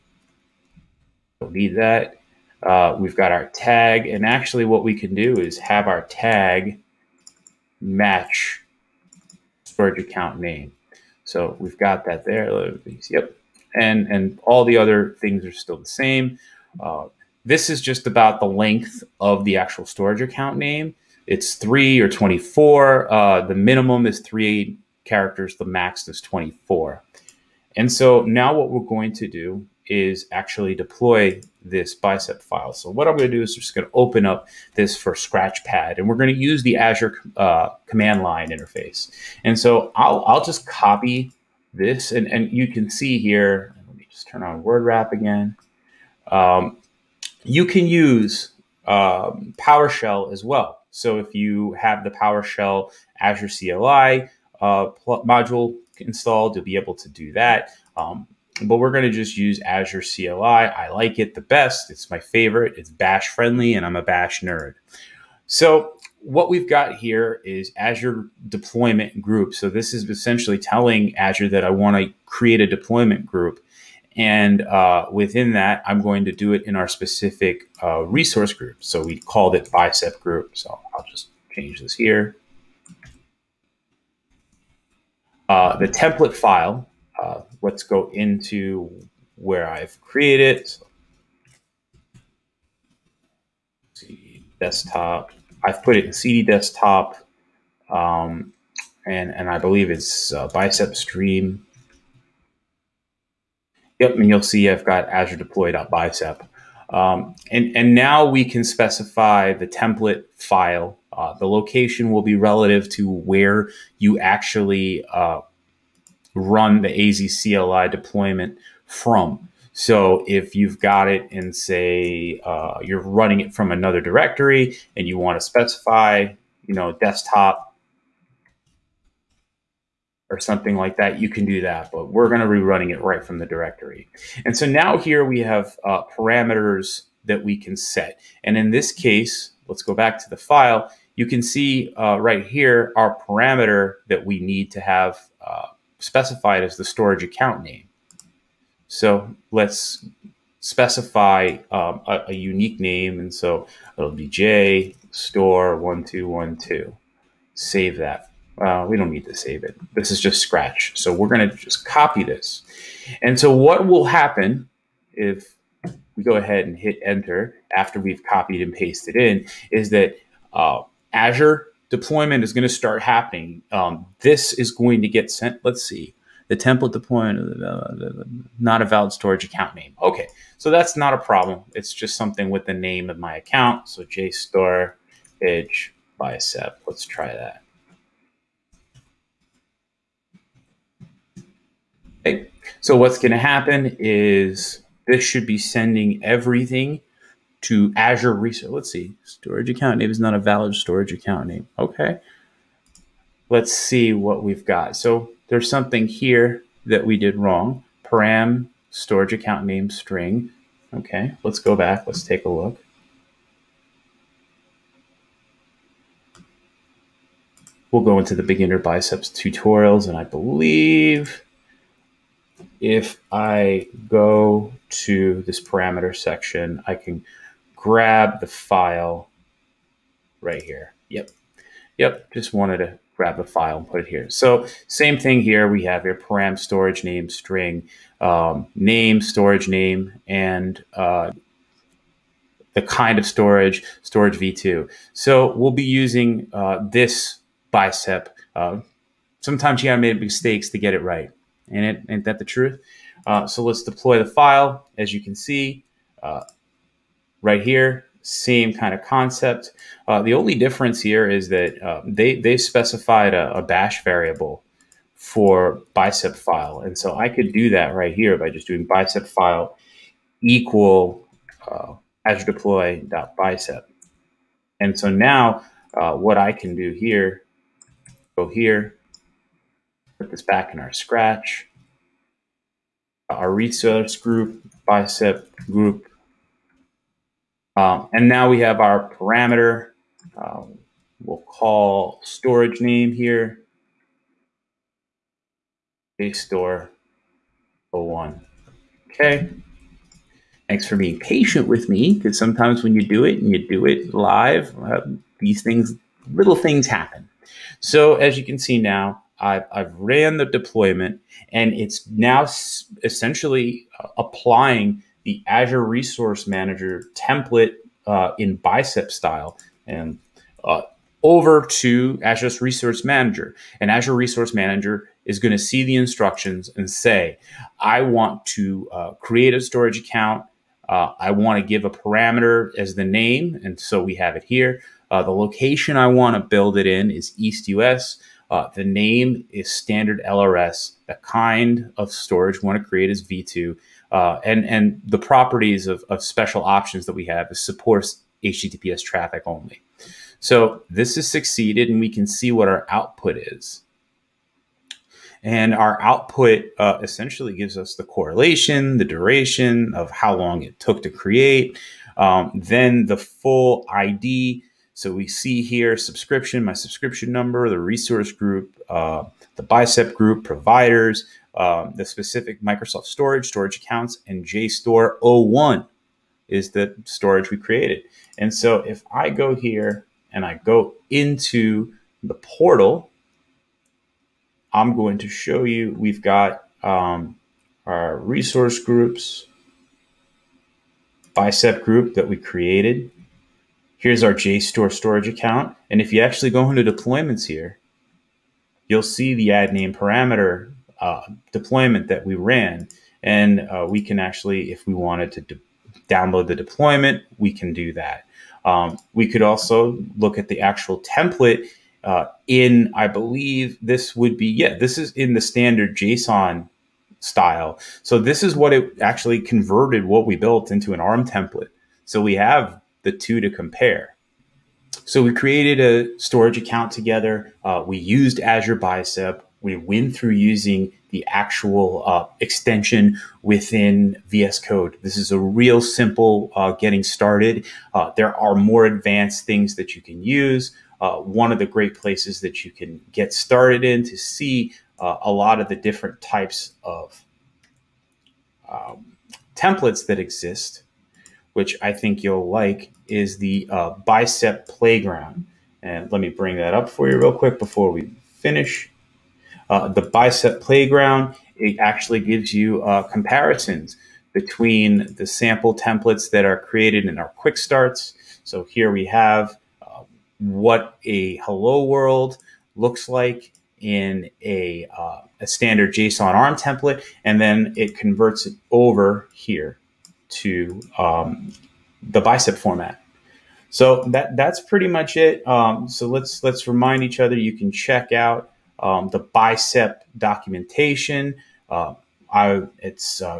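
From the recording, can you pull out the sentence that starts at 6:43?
And uh, we can actually, if we wanted to download the deployment, we can do that.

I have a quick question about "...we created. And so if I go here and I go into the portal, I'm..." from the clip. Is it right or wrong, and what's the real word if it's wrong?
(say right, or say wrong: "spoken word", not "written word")
right.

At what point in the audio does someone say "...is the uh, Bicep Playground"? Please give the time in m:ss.
7:33.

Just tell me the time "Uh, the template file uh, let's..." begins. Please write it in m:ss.
1:25.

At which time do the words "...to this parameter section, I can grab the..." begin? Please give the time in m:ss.
3:44.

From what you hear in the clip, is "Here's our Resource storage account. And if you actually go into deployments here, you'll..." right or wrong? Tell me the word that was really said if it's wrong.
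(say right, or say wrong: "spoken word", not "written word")
wrong: "JSTOR", not "Resource".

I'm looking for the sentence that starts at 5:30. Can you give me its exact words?
Uh, I want to give a parameter as the name.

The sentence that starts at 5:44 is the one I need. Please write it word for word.
Uh, and and the properties of, of special options that we have is supports HTTPS traffic only.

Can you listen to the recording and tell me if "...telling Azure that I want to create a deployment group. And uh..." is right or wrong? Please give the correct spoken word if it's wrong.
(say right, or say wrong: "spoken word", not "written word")
right.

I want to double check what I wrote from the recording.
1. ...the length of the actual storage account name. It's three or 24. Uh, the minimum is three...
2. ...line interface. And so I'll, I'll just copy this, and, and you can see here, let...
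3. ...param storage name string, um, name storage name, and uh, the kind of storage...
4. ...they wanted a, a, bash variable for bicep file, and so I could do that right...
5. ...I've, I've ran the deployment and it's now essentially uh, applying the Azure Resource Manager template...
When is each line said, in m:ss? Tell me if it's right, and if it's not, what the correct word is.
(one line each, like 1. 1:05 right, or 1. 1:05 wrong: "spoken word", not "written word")
1. 0:18 right
2. 0:38 right
3. 3:56 right
4. 4:22 wrong: "specified", not "wanted"
5. 5:09 right.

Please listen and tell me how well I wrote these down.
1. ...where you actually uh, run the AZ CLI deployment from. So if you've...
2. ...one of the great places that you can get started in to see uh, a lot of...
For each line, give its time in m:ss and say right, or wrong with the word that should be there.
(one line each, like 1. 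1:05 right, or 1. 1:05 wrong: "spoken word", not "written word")
1. 1:53 right
2. 7:21 right.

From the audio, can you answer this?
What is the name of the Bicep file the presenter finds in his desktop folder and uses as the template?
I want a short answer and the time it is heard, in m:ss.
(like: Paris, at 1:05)
Azure deploy.bicep, at 1:45.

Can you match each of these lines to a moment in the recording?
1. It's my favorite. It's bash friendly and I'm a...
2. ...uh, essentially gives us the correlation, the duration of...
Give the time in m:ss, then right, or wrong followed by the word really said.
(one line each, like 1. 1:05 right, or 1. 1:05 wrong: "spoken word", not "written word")
1. 1:01 right
2. 5:56 right.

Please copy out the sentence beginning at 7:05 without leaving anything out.
So we created a storage account together.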